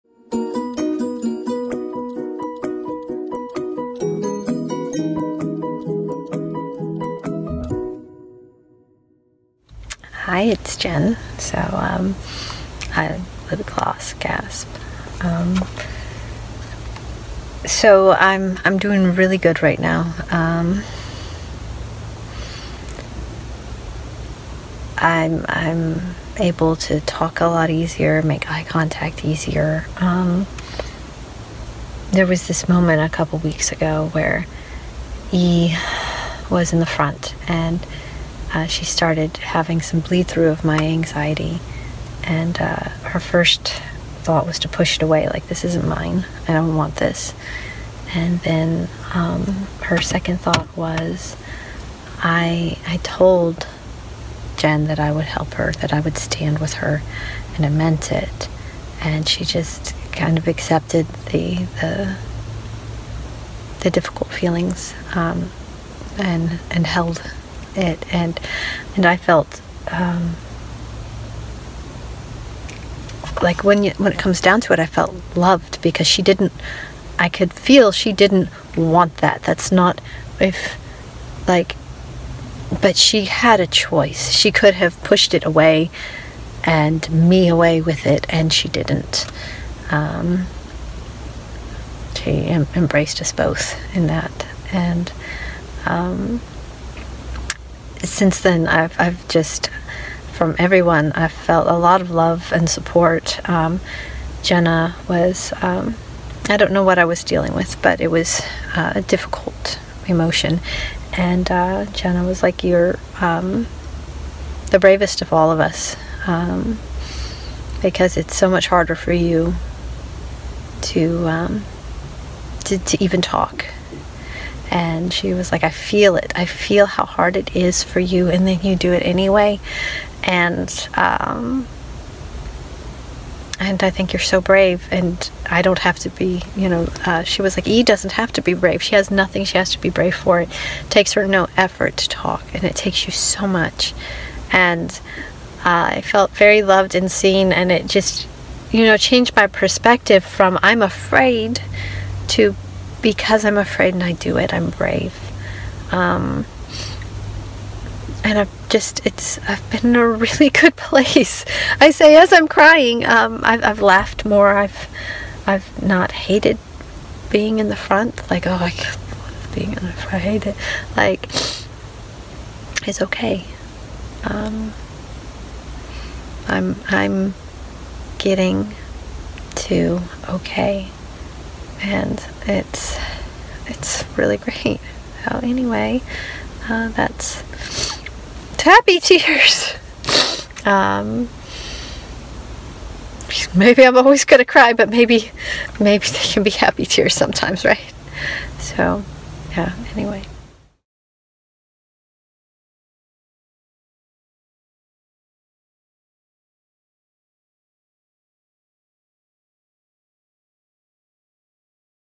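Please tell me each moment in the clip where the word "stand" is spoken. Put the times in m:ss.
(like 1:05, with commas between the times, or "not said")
0:56.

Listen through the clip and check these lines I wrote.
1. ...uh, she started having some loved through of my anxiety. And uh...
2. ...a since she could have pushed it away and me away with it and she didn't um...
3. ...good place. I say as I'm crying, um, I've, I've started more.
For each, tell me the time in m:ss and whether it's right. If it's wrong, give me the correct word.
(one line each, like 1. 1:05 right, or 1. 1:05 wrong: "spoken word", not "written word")
1. 0:38 wrong: "bleed", not "loved"
2. 1:23 wrong: "choice", not "since"
3. 2:40 wrong: "laughed", not "started".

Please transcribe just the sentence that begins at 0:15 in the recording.
Um, so I'm I'm doing really good right now.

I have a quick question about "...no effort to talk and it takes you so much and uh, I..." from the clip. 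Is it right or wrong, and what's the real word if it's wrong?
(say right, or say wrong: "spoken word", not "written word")
right.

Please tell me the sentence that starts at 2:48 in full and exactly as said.
Like, oh, I being in the front.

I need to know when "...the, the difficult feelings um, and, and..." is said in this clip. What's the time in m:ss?
1:01.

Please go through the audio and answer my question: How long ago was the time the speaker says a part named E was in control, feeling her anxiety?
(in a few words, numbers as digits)
a couple weeks ago.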